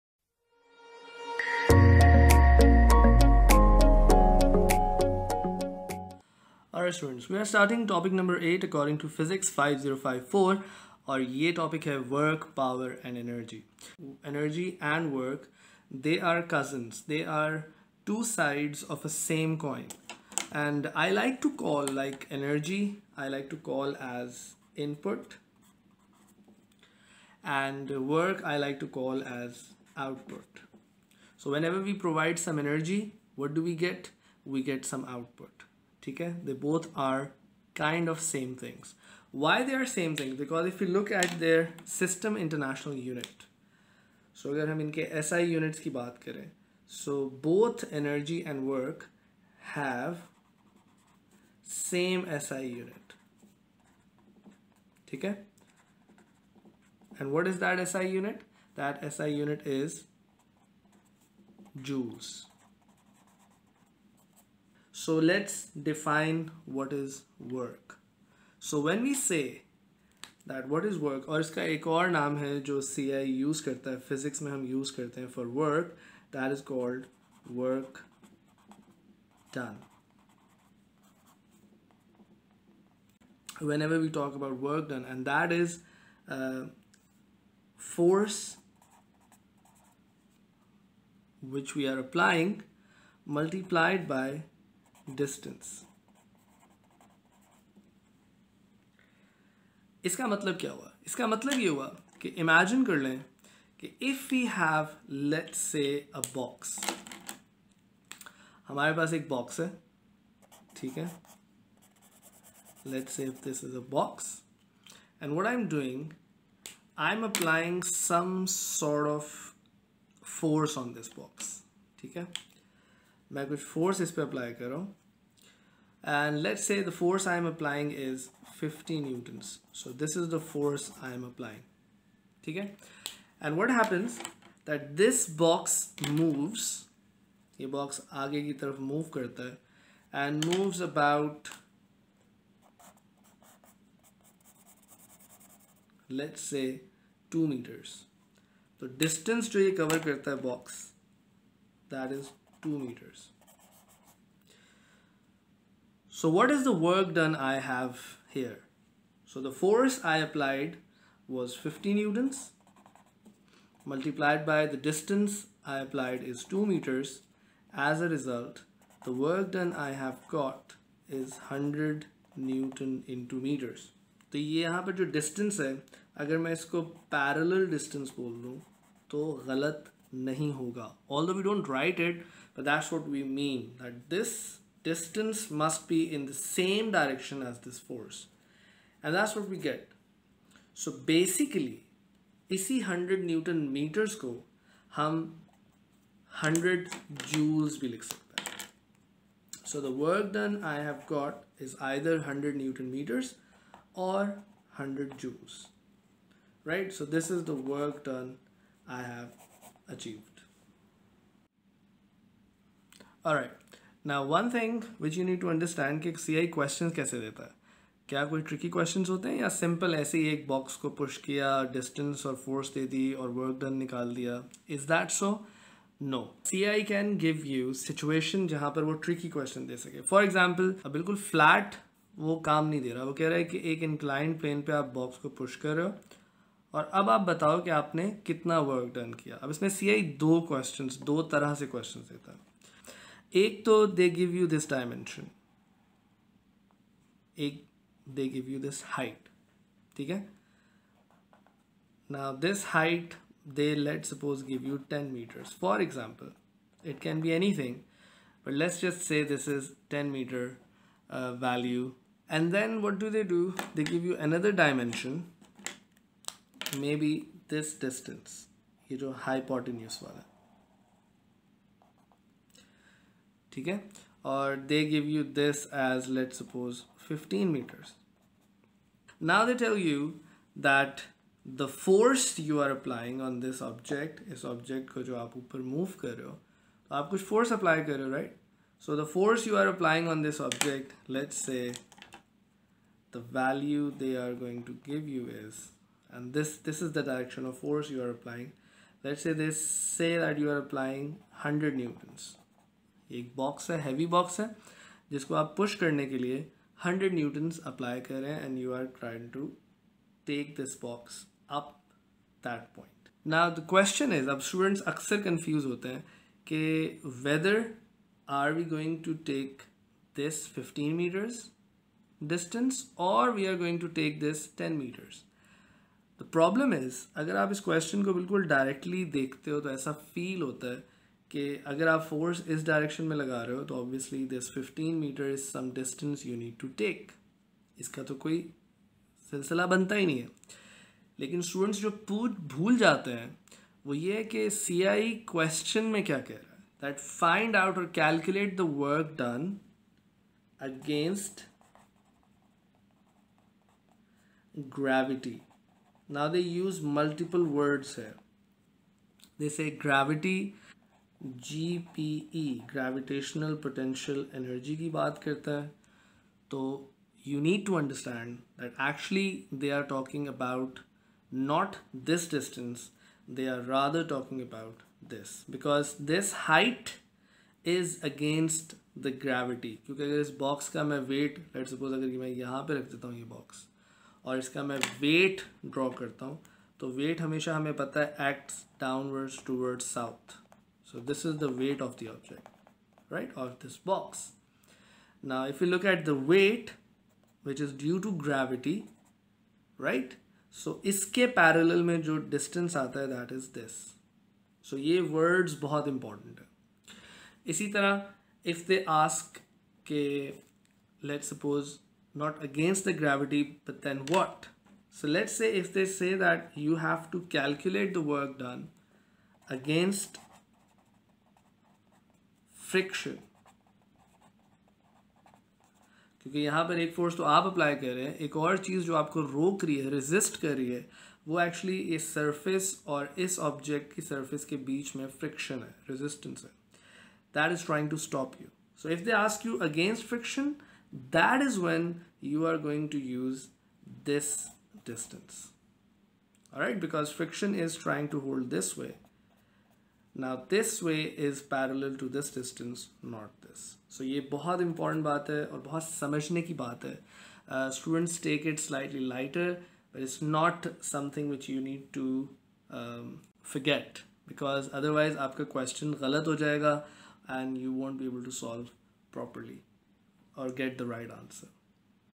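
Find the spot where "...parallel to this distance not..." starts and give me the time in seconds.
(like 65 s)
451 s.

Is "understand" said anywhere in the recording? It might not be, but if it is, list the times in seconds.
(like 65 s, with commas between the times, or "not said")
215 s, 367 s.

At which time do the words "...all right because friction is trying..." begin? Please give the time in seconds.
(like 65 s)
446 s.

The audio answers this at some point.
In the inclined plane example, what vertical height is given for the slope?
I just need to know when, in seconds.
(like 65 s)
254 s.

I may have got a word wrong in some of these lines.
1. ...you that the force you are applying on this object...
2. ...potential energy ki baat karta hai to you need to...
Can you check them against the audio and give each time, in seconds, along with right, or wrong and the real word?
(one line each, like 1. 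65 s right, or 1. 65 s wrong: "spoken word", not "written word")
1. 279 s right
2. 363 s right.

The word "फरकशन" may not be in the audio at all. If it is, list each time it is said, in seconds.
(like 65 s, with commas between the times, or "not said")
422 s, 435 s, 440 s.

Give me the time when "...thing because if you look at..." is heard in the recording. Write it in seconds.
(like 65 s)
40 s.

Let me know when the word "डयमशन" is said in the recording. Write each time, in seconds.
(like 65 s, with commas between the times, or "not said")
244 s, 264 s.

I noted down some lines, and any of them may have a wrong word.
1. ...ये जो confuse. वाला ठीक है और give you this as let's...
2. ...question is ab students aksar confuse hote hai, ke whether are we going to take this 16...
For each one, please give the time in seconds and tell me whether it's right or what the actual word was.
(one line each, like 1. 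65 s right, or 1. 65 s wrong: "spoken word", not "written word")
1. 268 s wrong: "hypotenuse", not "confuse"
2. 313 s wrong: "15", not "16".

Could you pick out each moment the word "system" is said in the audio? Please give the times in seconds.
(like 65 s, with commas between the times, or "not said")
41 s.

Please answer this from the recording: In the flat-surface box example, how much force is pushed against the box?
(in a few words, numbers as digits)
50 newtons.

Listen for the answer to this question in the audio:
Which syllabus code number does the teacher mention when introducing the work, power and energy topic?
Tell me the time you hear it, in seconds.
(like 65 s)
9 s.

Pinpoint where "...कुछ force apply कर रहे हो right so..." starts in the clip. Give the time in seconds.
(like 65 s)
287 s.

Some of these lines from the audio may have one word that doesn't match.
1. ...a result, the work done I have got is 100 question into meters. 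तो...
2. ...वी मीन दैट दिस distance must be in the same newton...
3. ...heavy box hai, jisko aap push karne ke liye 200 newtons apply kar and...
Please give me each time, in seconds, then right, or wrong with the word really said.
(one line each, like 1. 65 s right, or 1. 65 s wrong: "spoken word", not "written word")
1. 168 s wrong: "newton", not "question"
2. 183 s wrong: "direction", not "newton"
3. 303 s wrong: "100", not "200".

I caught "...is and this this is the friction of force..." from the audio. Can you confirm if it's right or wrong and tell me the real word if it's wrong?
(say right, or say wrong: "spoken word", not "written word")
wrong: "direction", not "friction".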